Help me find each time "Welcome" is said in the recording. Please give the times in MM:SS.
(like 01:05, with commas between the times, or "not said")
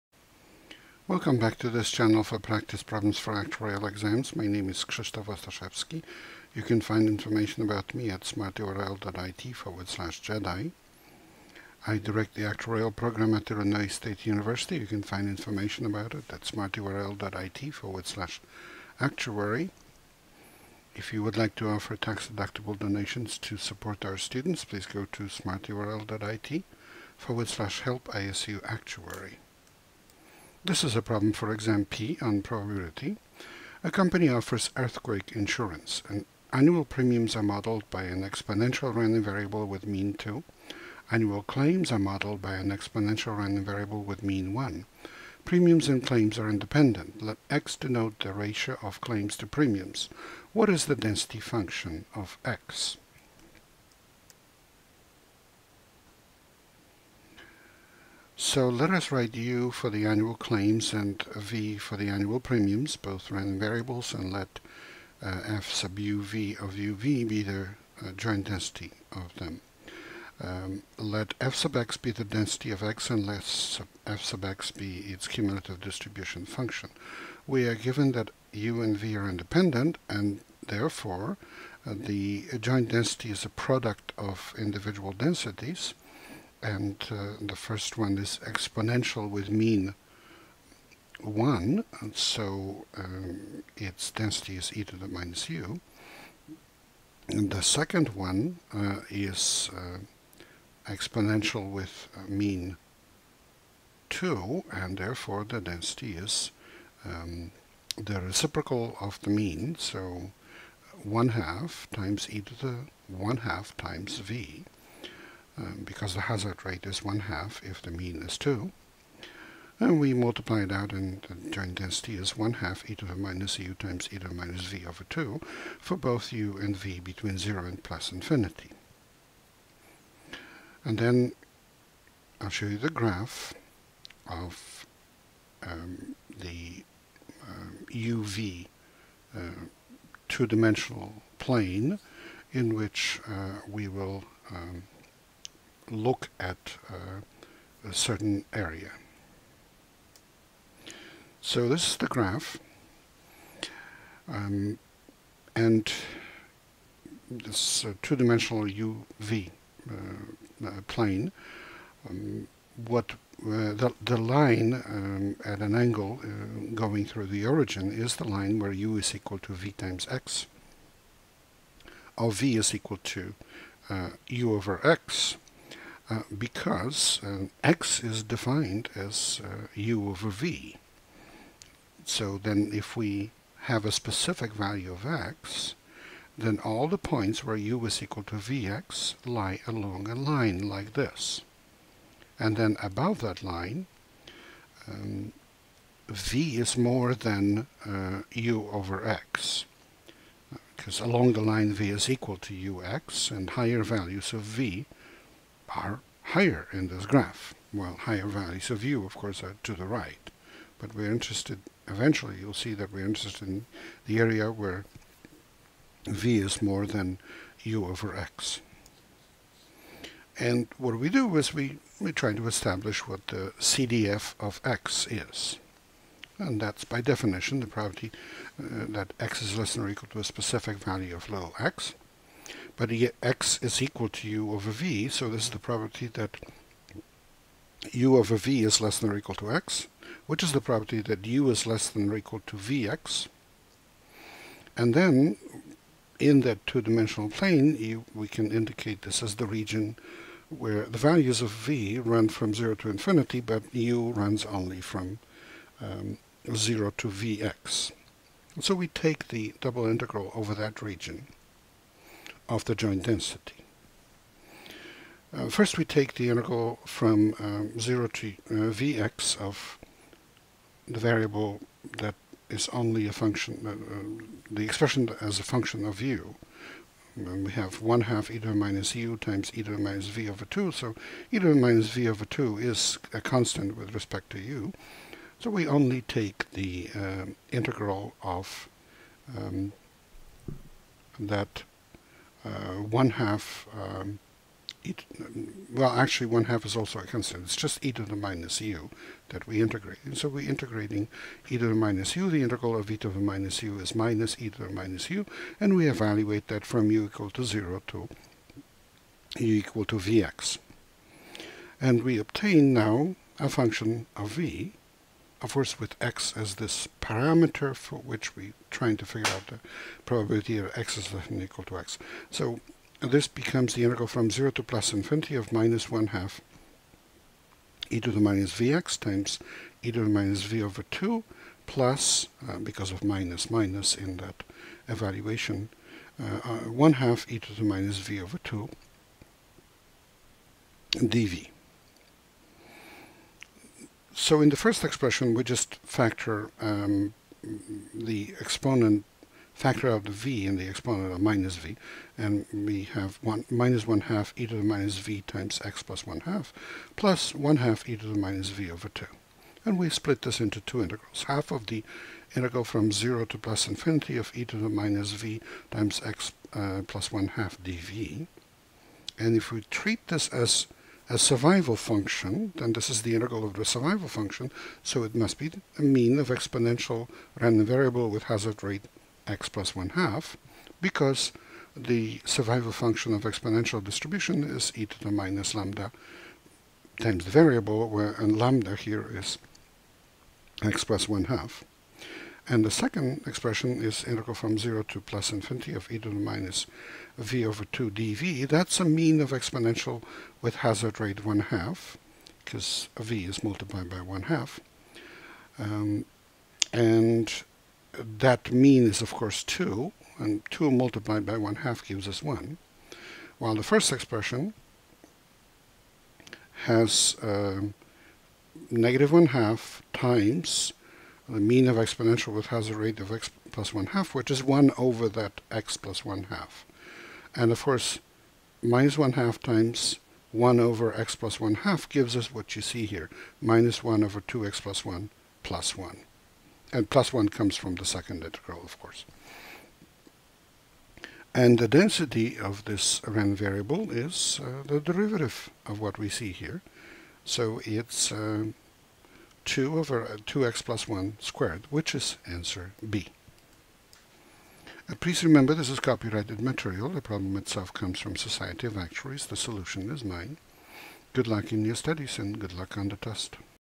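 00:01.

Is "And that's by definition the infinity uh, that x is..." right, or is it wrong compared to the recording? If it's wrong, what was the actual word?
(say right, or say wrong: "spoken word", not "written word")
wrong: "property", not "infinity".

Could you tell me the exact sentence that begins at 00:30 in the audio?
This is a problem for exam P on probability.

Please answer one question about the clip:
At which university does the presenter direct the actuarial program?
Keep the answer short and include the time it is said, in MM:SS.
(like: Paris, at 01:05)
Illinois State University, at 00:13.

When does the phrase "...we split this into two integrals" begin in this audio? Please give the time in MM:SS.
05:59.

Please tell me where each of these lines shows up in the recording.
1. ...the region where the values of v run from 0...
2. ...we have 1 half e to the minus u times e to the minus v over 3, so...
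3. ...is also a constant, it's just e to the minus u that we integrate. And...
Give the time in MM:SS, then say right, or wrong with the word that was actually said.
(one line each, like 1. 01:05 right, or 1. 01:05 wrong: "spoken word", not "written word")
1. 04:09 right
2. 04:37 wrong: "2", not "3"
3. 04:56 right.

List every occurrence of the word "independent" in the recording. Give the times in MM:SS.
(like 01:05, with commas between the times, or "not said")
00:46, 01:19.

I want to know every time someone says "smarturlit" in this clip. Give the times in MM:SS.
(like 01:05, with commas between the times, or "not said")
00:08, 00:16, 00:25.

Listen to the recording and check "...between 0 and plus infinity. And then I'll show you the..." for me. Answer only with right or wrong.
right.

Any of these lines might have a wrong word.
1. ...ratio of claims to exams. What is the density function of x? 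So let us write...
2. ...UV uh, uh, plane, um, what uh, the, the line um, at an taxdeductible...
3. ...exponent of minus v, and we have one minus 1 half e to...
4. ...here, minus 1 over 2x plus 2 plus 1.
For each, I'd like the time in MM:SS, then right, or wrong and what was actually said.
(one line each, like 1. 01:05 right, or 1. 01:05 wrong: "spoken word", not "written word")
1. 00:48 wrong: "premiums", not "exams"
2. 02:38 wrong: "angle", not "taxdeductible"
3. 05:50 right
4. 07:12 wrong: "1", not "2".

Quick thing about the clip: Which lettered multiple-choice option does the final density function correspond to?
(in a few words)
B.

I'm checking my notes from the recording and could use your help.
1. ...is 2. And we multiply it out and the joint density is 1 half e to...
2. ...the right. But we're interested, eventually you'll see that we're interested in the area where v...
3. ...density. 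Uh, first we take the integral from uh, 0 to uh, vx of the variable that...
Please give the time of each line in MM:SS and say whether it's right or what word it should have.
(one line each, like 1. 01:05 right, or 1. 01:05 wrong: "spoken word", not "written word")
1. 01:58 right
2. 03:29 right
3. 04:23 right.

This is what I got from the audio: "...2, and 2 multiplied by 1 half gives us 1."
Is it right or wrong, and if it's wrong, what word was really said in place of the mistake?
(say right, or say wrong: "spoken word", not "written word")
right.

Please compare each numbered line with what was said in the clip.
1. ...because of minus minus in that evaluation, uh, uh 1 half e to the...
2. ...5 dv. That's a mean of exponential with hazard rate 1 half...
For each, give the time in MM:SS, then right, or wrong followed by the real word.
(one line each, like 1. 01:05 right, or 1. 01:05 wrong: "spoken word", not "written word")
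1. 05:32 right
2. 06:37 wrong: "2", not "5".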